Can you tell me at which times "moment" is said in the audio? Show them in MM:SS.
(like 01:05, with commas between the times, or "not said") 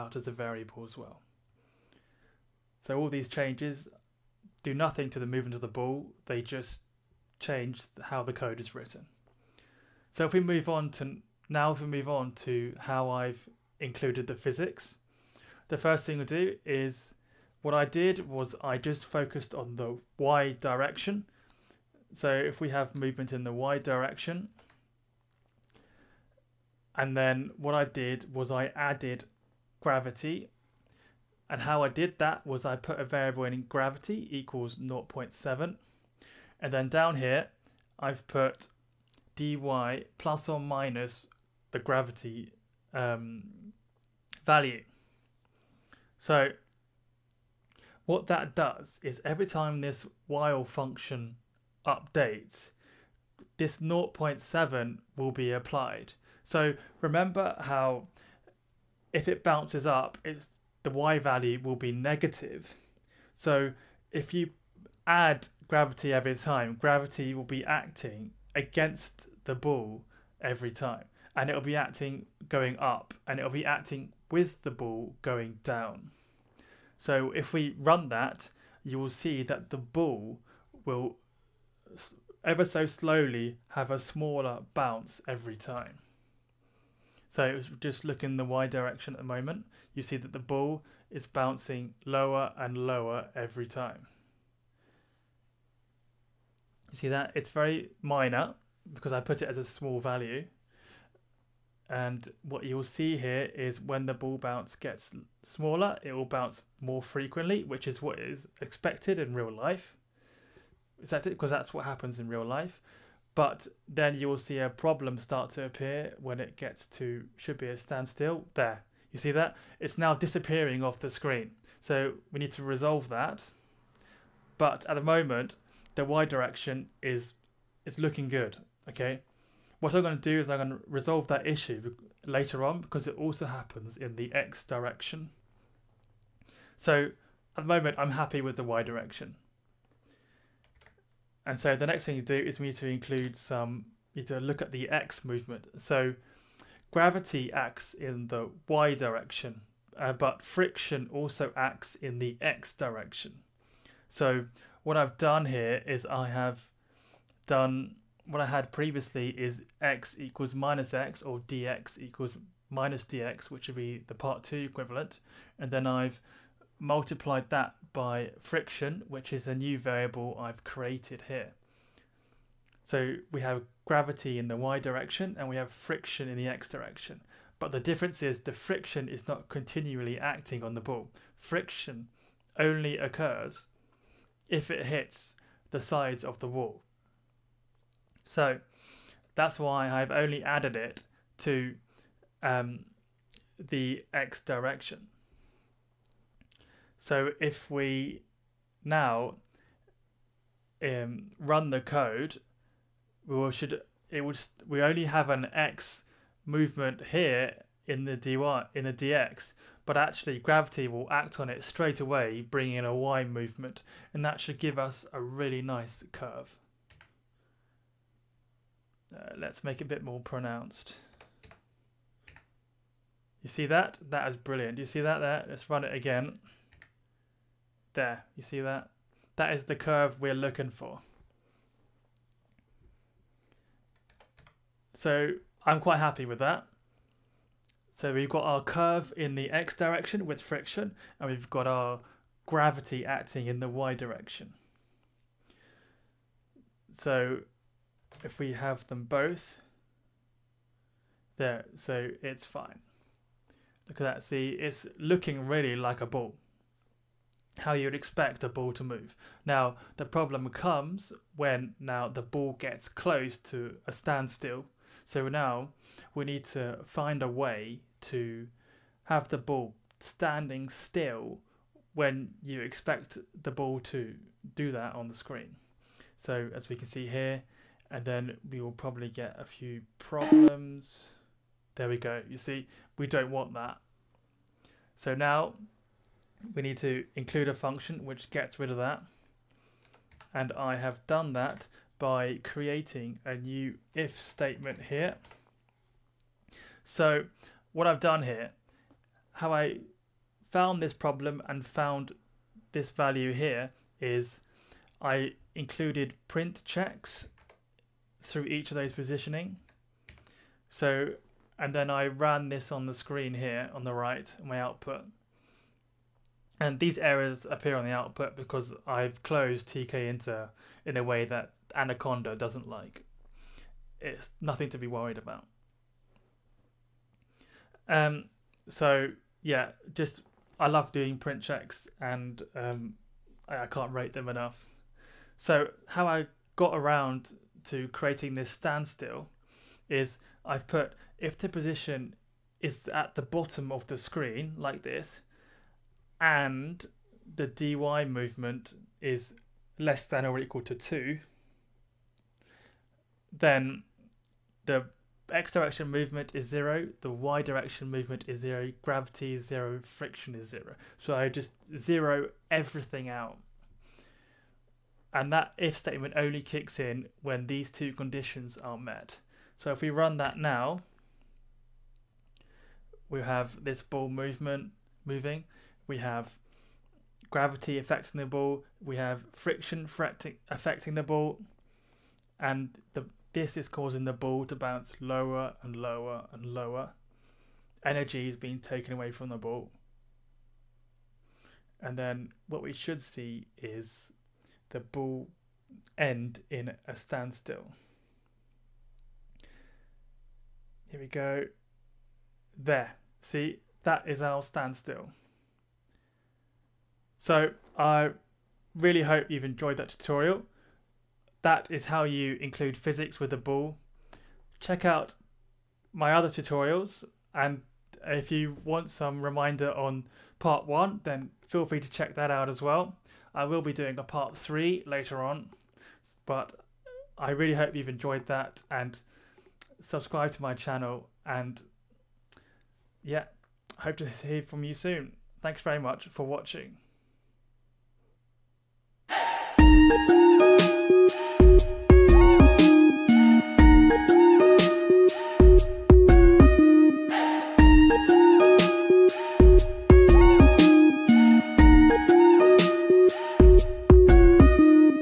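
01:29, 02:04, 02:17.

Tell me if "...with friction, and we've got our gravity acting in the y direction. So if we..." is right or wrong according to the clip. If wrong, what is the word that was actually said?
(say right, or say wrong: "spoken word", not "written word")
right.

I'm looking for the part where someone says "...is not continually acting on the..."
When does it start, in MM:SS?
02:59.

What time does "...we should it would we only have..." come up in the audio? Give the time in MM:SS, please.
03:23.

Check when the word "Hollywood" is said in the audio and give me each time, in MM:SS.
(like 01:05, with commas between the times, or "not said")
not said.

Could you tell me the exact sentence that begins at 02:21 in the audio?
And so the next thing you do is we need to include some, you need to look at the x movement.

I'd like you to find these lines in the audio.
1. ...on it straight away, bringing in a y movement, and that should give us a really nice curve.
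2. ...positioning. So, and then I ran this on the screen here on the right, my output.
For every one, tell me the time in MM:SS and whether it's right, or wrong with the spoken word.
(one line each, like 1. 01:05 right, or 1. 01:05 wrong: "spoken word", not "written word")
1. 03:31 right
2. 05:08 right.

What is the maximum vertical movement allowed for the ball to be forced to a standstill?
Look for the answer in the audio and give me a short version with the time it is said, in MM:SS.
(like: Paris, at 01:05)
2, at 05:50.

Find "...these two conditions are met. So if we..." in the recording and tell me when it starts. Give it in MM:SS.
06:07.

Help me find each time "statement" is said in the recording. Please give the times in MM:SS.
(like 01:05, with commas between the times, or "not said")
04:54, 06:05.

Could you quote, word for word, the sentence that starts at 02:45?
And then I've multiplied that by friction, which is a new variable I've created here.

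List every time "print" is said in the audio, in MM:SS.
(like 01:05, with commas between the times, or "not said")
05:06, 05:31.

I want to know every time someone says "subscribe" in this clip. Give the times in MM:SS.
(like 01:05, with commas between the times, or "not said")
07:09.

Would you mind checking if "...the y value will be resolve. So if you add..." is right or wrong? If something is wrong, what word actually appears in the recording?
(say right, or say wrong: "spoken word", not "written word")
wrong: "negative", not "resolve".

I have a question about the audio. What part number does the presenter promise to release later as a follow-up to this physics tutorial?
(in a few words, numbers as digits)
part three.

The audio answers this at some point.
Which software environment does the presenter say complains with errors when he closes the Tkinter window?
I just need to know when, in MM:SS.
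05:21.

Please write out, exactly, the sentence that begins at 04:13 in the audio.
Look at that, see, it's looking really like a ball how you'd expect a ball to move.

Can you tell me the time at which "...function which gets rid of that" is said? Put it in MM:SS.
04:47.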